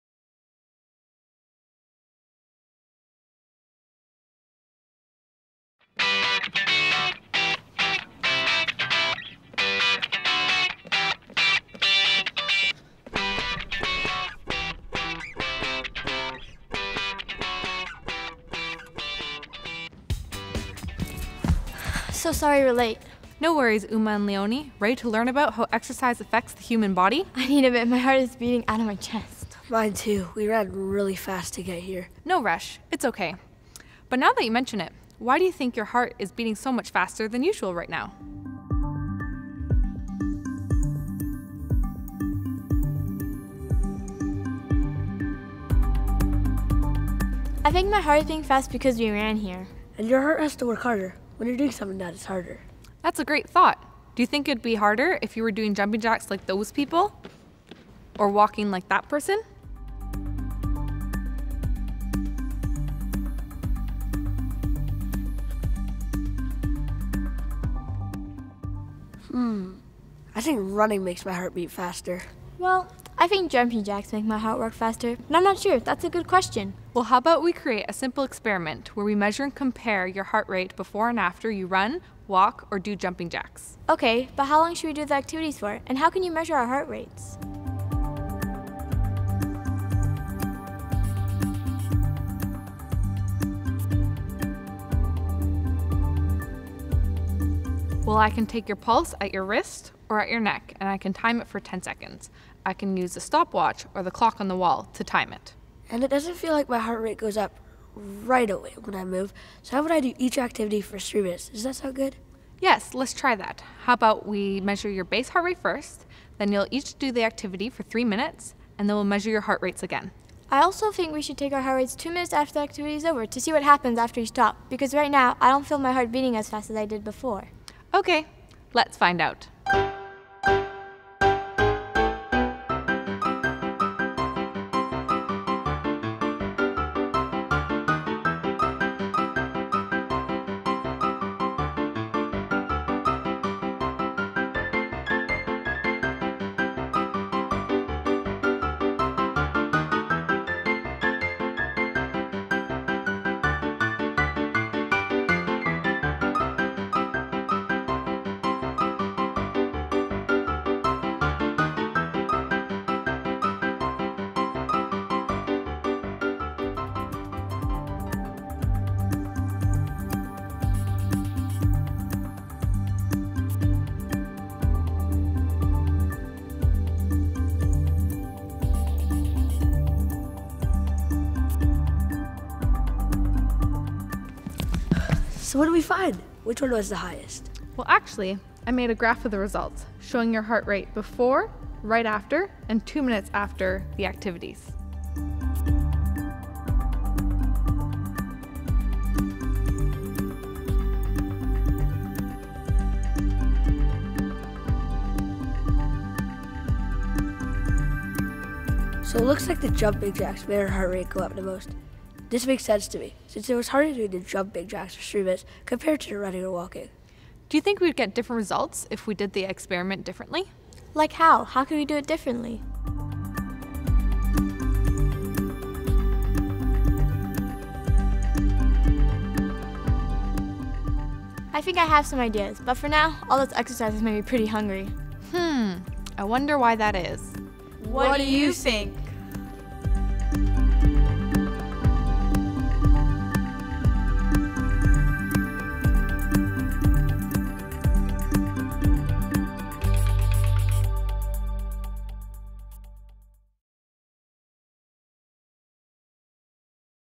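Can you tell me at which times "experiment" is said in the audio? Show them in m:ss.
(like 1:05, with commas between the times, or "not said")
1:18, 3:39.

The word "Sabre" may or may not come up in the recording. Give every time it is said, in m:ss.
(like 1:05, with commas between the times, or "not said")
not said.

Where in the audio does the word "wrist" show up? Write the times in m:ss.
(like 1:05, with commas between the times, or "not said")
1:39.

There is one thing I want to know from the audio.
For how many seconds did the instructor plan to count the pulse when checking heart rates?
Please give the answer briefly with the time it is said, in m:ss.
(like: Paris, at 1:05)
10 seconds, at 1:41.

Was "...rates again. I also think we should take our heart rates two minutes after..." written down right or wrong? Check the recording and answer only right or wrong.
right.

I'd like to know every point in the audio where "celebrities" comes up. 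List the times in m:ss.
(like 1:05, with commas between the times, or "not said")
not said.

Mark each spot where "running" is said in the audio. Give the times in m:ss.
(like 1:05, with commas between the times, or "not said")
1:10, 3:36.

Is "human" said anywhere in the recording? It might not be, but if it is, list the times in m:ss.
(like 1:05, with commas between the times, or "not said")
0:26.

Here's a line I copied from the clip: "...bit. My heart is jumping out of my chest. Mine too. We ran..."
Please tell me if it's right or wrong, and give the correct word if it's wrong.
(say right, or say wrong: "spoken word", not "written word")
wrong: "beating", not "jumping".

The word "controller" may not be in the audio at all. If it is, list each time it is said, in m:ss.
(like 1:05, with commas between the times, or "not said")
not said.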